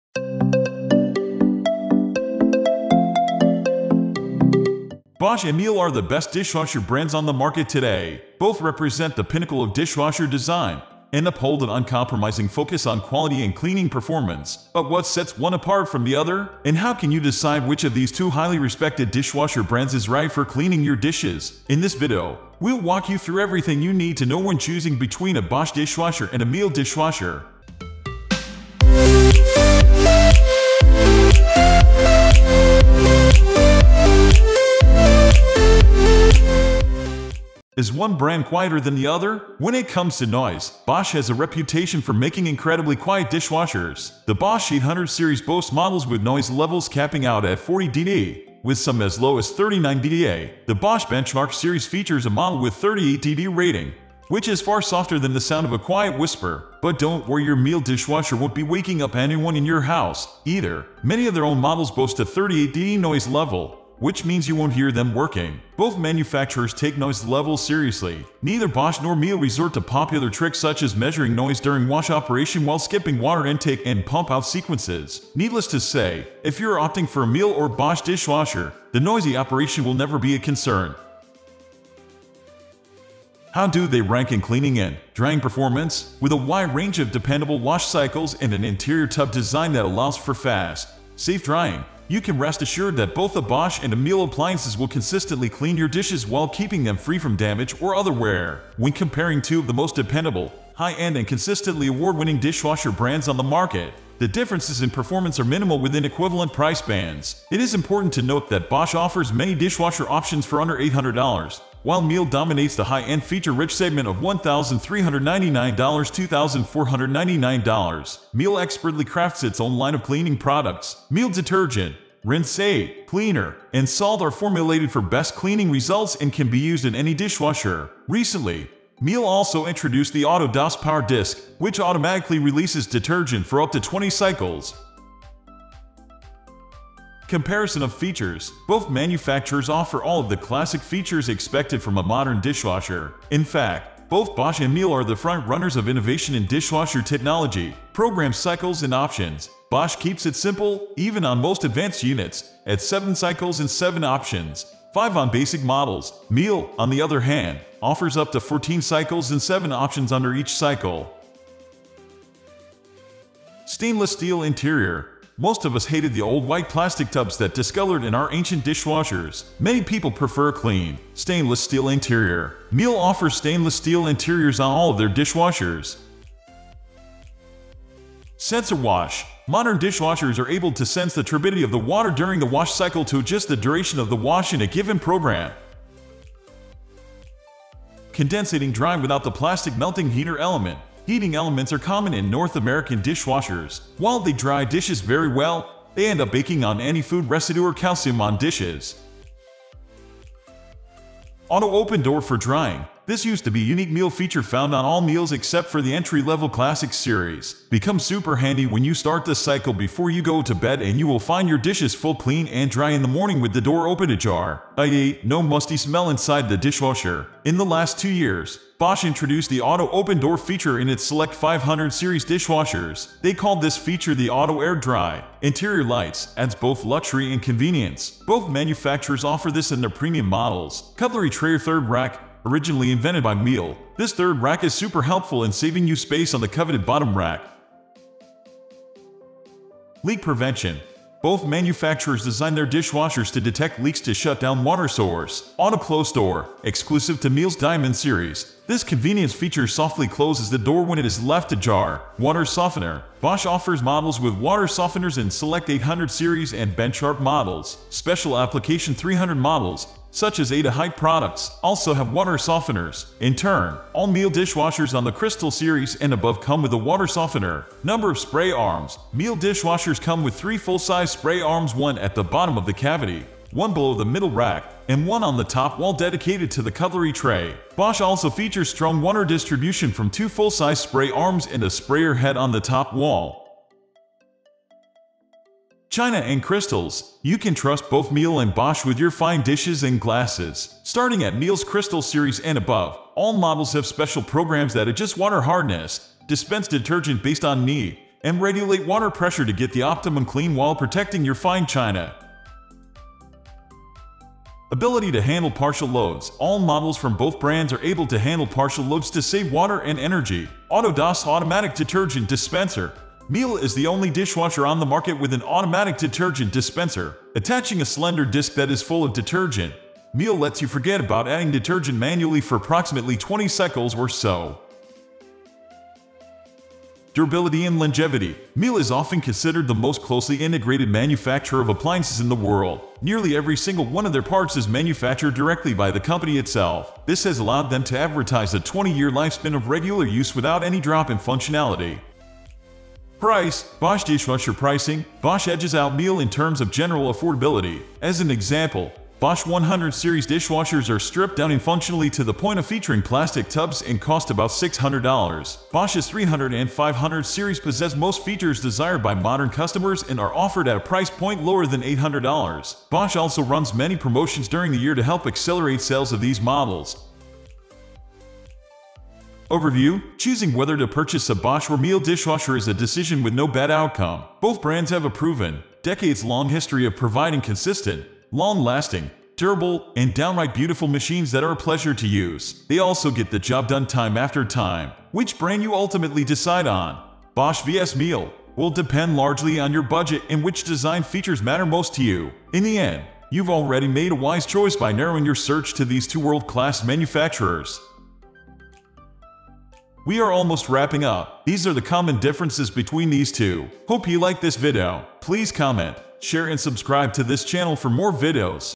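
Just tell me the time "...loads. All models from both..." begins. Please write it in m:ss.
5:05.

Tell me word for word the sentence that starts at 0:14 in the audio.
But what sets one apart from the other?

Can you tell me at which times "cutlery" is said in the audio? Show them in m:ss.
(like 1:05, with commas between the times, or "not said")
3:50, 4:36.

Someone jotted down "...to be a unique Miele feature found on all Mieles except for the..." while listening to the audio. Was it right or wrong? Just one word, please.
right.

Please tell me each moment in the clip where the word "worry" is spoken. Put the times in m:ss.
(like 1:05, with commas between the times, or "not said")
0:57.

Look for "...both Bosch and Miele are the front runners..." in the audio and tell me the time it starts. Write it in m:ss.
2:24.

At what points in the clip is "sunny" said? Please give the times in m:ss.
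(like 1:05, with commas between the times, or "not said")
not said.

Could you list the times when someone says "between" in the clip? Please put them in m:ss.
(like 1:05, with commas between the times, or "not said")
0:24, 6:42.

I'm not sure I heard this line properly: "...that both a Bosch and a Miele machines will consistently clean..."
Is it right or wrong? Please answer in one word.
wrong.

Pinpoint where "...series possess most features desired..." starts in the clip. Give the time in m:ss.
5:57.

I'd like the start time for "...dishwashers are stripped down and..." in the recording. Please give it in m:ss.
5:50.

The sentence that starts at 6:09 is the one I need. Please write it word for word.
Overview Choosing whether to purchase a Bosch or Miele dishwasher is a decision with no bad outcome.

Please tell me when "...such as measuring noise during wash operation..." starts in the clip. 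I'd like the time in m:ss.
1:10.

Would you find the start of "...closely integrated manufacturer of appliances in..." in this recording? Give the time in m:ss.
5:30.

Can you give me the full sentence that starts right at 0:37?
Is one brand quieter than the other?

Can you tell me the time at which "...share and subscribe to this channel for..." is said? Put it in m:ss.
6:46.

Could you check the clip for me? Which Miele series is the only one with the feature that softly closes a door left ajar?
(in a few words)
Diamond series.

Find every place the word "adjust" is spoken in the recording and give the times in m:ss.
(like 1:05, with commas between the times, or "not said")
3:03, 4:54.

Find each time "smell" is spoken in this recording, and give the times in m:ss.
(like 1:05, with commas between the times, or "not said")
3:35.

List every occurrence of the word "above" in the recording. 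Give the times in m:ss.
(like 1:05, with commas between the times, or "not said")
4:26, 4:52.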